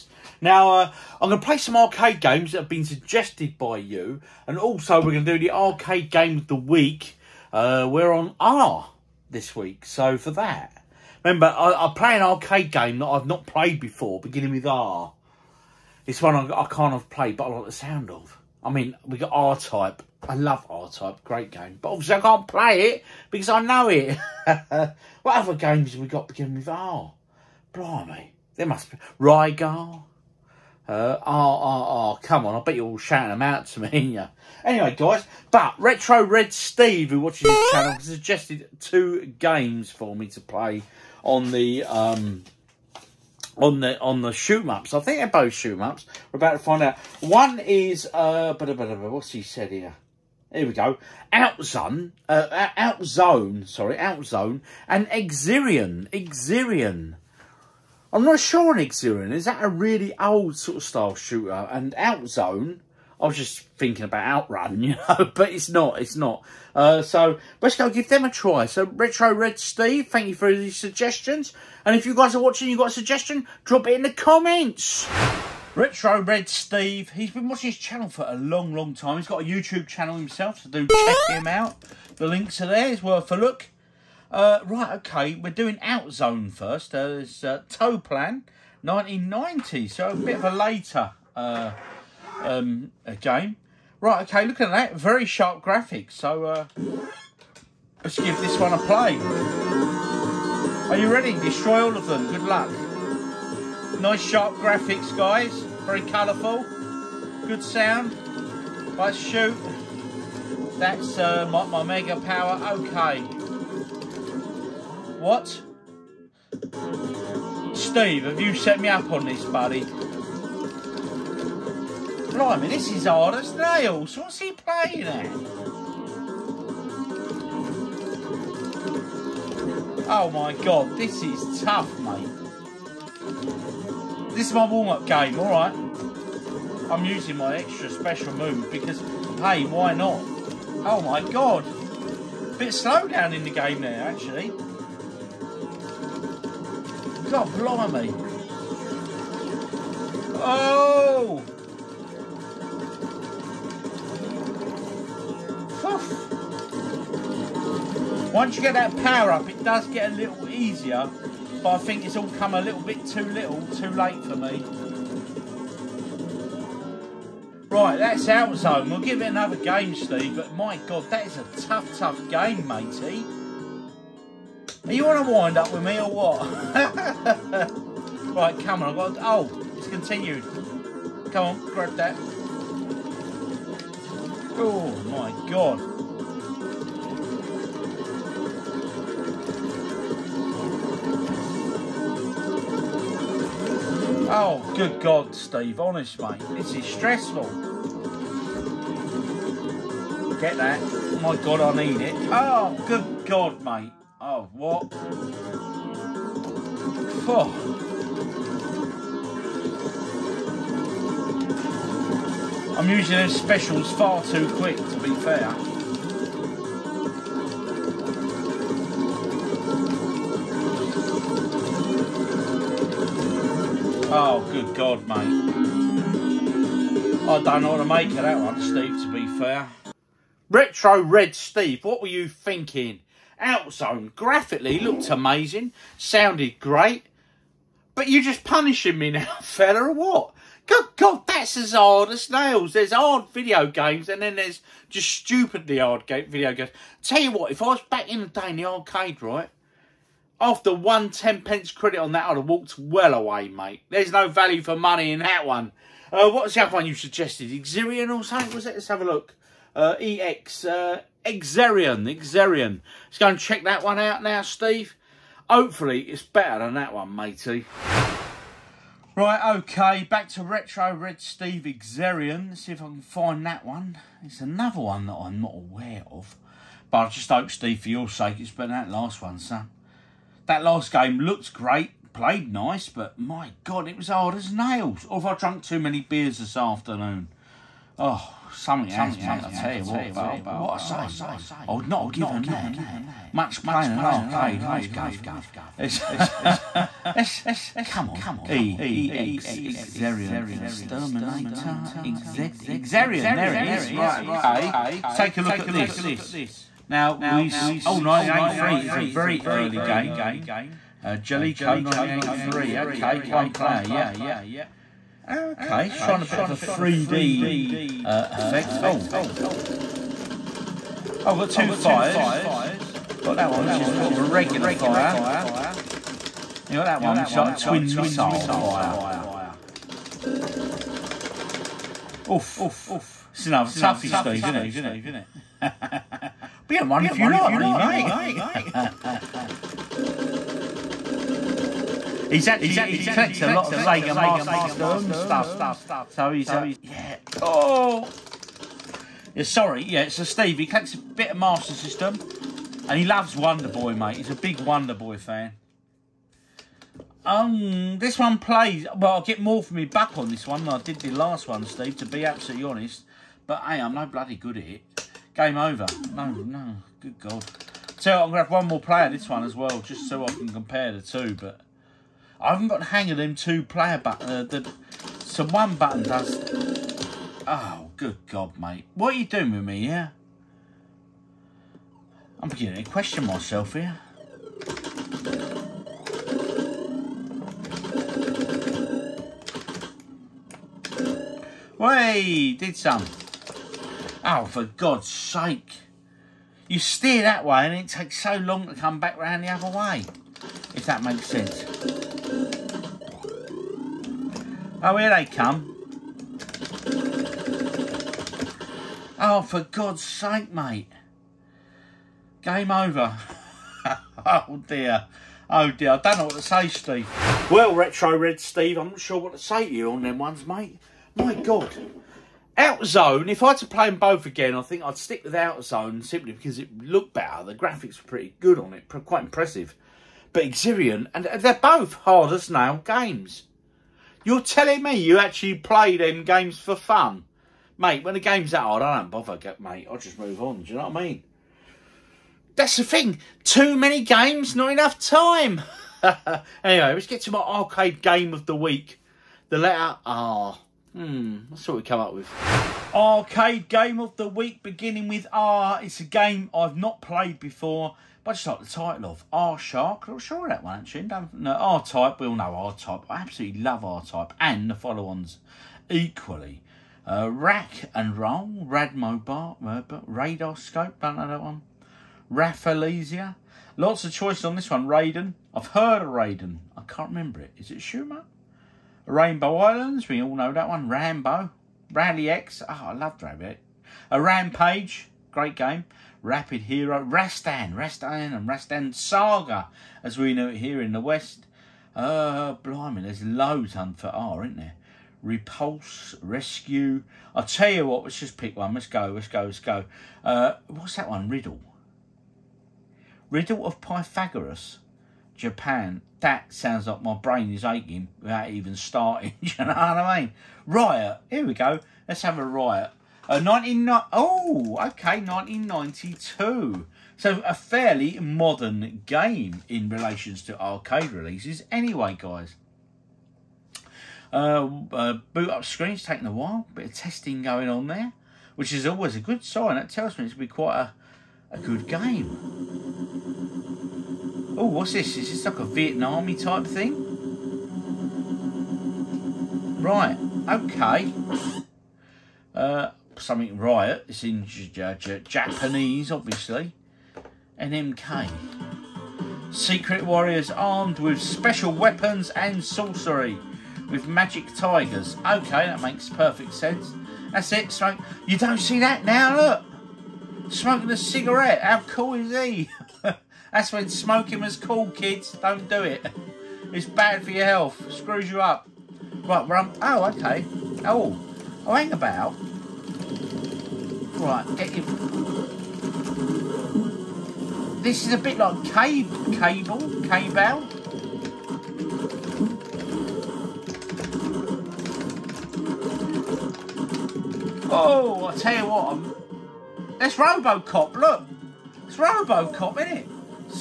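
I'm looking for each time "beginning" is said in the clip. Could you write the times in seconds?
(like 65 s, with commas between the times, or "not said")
14 s, 26 s, 382 s, 454 s.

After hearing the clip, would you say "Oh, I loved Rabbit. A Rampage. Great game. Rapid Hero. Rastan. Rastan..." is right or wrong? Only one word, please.
right.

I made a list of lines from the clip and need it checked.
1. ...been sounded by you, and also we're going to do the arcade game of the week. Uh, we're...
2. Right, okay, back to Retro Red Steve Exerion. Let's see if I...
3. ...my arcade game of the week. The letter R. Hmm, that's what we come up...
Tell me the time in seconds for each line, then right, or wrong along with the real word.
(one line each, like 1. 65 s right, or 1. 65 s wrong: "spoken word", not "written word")
1. 2 s wrong: "suggested", not "sounded"
2. 269 s right
3. 447 s right.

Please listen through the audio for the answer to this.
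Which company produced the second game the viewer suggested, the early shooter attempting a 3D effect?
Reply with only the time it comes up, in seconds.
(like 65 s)
311 s.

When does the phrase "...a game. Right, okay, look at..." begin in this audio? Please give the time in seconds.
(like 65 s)
93 s.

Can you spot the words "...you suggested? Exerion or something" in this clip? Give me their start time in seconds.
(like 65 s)
256 s.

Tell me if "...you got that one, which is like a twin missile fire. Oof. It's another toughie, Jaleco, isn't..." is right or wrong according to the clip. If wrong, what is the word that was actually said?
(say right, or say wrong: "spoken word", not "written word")
wrong: "Steve", not "Jaleco".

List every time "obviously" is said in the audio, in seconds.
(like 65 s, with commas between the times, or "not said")
21 s, 546 s.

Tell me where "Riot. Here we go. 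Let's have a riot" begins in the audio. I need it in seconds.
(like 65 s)
510 s.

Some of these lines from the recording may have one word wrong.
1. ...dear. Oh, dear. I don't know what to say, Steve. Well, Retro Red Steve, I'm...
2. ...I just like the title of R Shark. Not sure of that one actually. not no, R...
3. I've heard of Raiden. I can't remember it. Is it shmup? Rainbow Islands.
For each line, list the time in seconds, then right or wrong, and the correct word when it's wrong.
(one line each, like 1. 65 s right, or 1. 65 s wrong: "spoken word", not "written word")
1. 414 s right
2. 458 s right
3. 475 s right.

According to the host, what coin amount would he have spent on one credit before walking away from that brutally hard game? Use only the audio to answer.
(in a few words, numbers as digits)
ten pence.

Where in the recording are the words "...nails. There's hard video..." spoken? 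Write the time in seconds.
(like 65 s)
242 s.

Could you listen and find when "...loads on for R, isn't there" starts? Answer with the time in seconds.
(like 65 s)
493 s.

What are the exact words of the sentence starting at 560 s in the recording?
Smoking a cigarette, how cool is he?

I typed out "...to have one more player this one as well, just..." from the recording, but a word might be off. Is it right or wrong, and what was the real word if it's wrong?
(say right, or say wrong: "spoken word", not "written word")
right.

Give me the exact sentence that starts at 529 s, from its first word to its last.
That tells me it's going to be quite a, a good game.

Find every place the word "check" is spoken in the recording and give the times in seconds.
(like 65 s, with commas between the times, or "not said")
80 s, 263 s.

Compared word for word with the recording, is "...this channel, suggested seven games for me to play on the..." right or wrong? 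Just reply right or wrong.
wrong.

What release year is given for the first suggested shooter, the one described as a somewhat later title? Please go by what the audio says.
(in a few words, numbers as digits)
1990.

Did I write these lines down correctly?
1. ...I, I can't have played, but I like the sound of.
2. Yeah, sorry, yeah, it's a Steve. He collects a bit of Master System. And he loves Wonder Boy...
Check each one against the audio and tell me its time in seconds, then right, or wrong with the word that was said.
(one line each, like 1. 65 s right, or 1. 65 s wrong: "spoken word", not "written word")
1. 16 s right
2. 349 s right.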